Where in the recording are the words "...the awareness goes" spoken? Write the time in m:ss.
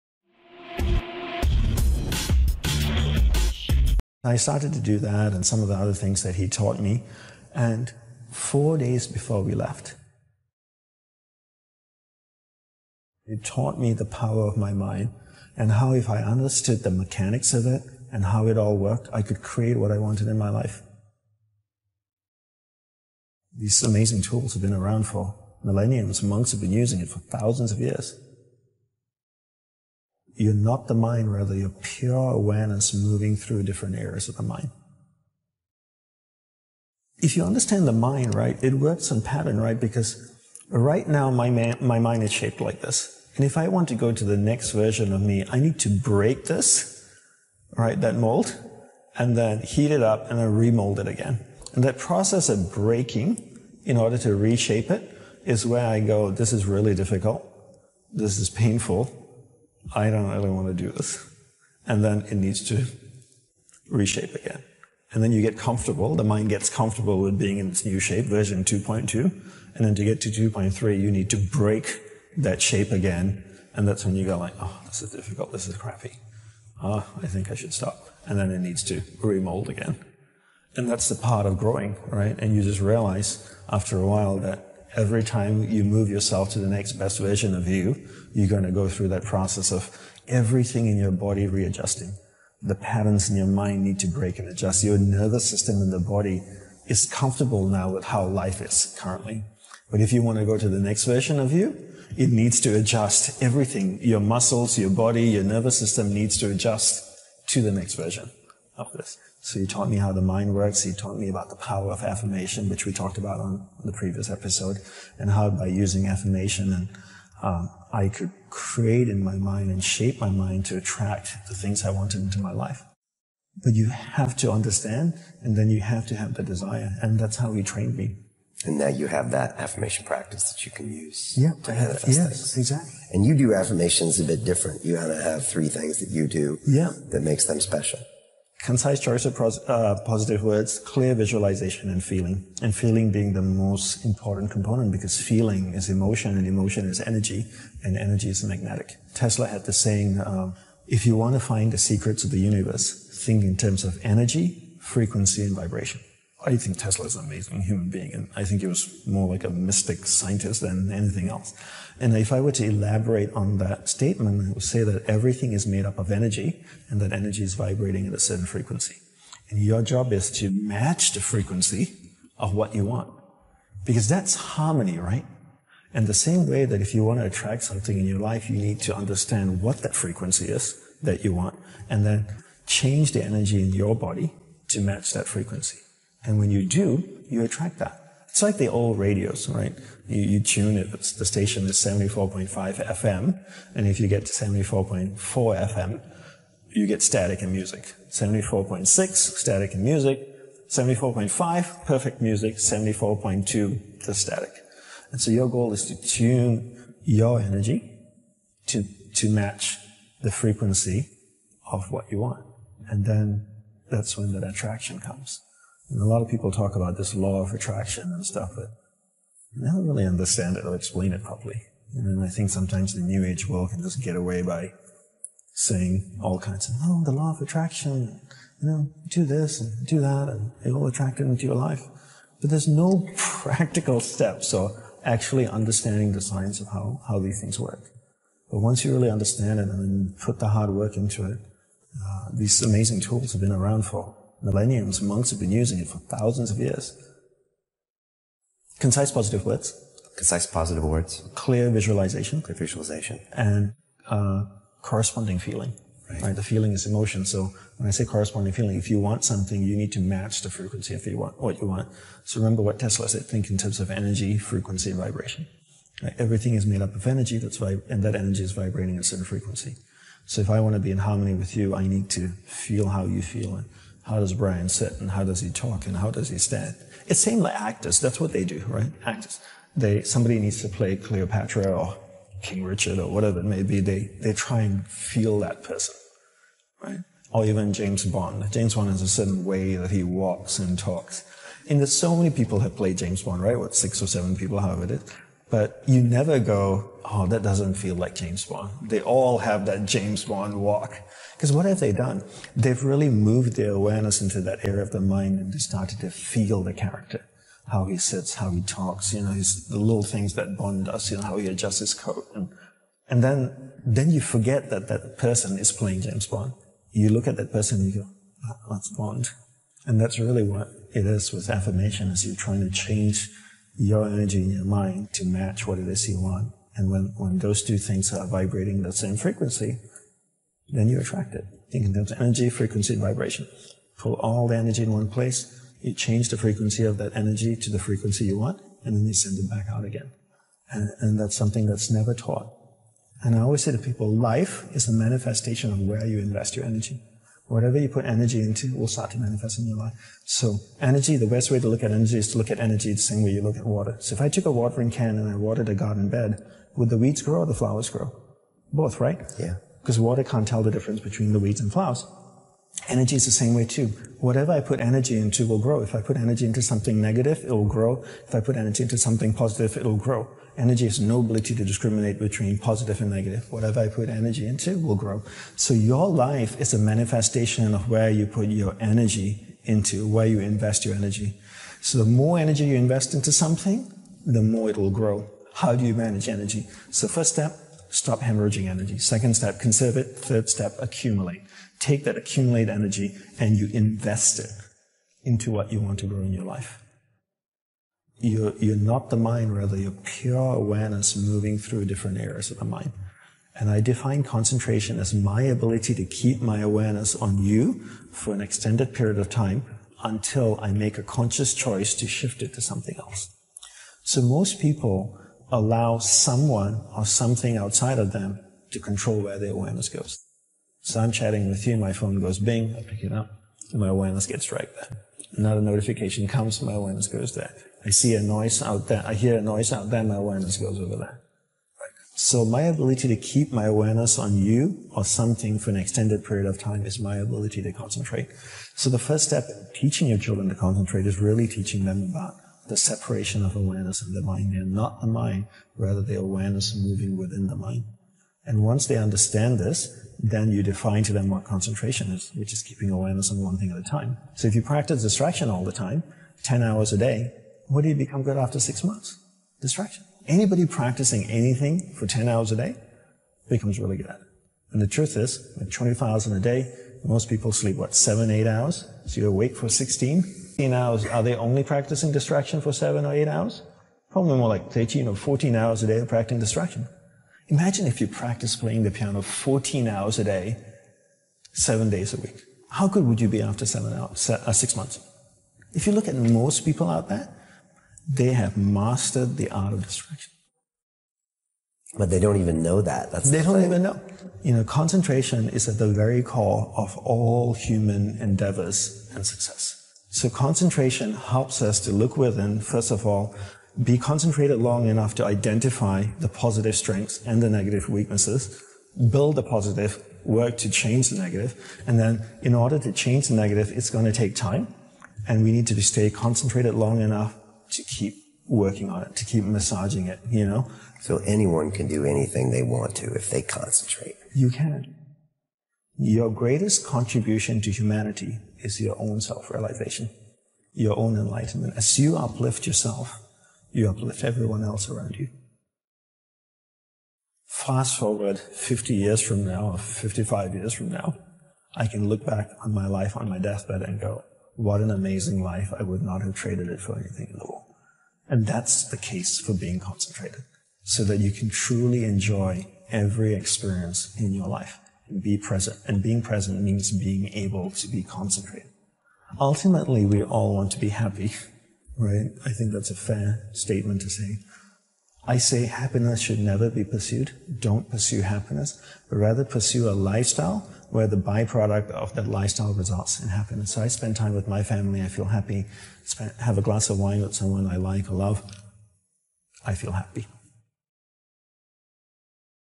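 6:59.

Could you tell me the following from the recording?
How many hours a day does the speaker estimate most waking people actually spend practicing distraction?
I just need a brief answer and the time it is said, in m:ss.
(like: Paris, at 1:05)
13 or 14, at 7:54.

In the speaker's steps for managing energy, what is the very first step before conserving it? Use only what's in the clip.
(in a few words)
Stop hemorrhaging energy.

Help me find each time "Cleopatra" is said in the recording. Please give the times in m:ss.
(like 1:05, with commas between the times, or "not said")
4:40.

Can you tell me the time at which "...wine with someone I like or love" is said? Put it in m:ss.
9:36.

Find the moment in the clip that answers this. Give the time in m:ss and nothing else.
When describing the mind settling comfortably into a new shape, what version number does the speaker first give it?
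1:08.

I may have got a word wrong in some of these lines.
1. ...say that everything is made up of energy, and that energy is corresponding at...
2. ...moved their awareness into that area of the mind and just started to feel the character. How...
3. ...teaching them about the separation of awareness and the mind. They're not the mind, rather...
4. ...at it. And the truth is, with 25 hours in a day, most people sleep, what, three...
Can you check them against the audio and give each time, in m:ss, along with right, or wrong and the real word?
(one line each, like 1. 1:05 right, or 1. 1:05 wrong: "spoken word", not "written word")
1. 2:44 wrong: "vibrating", not "corresponding"
2. 5:03 right
3. 7:21 right
4. 7:44 wrong: "seven", not "three".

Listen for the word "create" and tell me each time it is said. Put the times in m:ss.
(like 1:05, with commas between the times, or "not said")
0:19, 1:58.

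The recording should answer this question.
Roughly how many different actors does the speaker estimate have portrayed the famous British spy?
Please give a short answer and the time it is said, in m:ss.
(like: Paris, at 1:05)
6 or 7, at 4:53.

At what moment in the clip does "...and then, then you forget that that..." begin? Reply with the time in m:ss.
5:13.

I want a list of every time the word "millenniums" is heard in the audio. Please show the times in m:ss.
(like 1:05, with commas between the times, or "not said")
0:25, 4:04.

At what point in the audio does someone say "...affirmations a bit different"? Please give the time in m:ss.
2:13.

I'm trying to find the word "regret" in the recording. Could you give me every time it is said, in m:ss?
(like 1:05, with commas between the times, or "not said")
not said.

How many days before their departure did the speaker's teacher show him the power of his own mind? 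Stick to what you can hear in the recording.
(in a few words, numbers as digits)
4.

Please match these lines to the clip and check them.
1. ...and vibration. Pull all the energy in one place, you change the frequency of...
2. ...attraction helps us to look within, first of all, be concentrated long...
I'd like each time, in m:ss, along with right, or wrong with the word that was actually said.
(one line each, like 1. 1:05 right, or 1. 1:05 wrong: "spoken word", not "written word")
1. 5:32 right
2. 8:20 wrong: "concentration", not "attraction".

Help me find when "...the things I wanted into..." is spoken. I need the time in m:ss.
2:01.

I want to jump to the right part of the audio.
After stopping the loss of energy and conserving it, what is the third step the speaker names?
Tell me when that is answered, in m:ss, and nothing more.
6:30.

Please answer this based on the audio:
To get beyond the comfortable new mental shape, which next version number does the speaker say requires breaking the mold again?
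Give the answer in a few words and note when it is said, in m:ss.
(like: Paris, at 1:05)
2.3, at 1:10.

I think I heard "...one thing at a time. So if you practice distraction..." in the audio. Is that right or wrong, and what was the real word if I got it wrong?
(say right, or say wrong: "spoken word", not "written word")
right.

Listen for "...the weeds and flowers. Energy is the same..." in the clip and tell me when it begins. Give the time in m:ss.
6:01.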